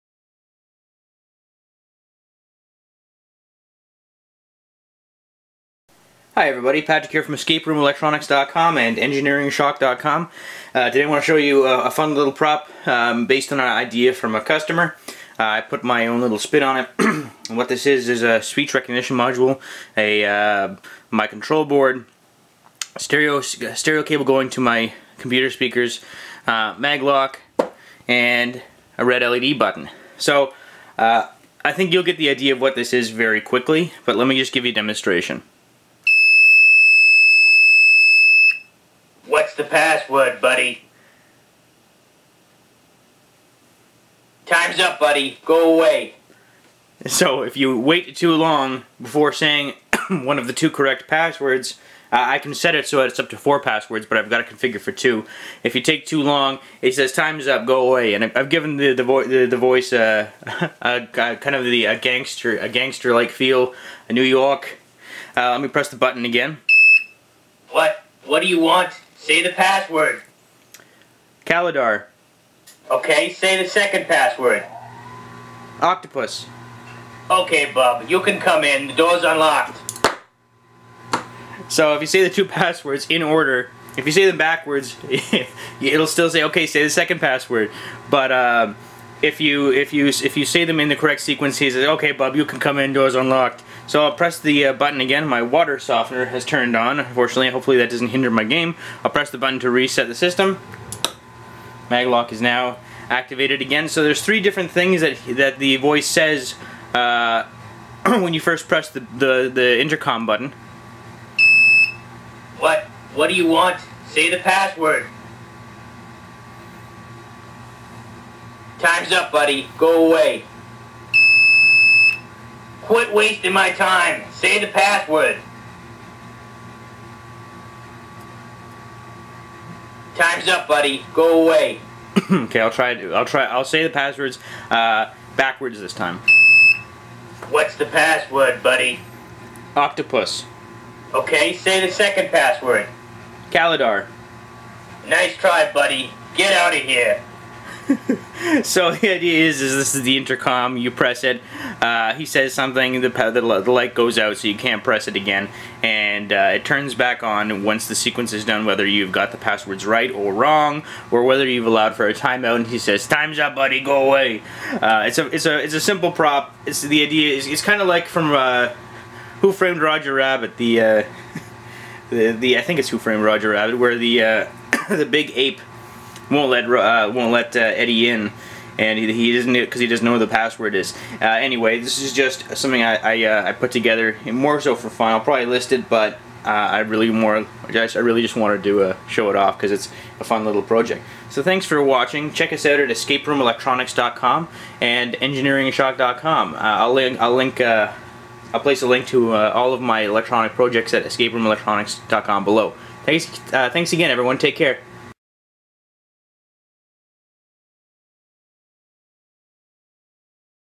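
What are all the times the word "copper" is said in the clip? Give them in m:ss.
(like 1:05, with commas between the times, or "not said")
not said.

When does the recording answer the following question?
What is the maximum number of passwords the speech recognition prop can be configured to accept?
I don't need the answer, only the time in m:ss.
0:53.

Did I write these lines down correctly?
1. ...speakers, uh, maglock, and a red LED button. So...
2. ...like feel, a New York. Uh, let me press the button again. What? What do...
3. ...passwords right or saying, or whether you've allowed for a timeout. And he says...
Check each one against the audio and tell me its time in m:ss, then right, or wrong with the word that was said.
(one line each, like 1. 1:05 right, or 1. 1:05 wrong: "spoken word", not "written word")
1. 0:25 right
2. 1:03 right
3. 2:39 wrong: "wrong", not "saying".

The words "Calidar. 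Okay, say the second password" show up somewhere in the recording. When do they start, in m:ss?
1:11.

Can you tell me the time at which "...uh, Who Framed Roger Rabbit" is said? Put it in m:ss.
2:48.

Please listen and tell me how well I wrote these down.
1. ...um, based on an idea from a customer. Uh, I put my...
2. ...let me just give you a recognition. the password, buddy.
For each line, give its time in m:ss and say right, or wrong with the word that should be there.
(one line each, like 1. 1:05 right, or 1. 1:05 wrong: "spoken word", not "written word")
1. 0:12 right
2. 0:34 wrong: "demonstration", not "recognition".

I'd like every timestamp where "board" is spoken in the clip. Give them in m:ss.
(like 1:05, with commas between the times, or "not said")
0:21.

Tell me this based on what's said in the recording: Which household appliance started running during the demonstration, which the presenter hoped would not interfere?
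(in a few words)
Water softener.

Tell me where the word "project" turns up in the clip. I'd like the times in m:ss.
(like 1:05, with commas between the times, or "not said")
3:10, 3:20.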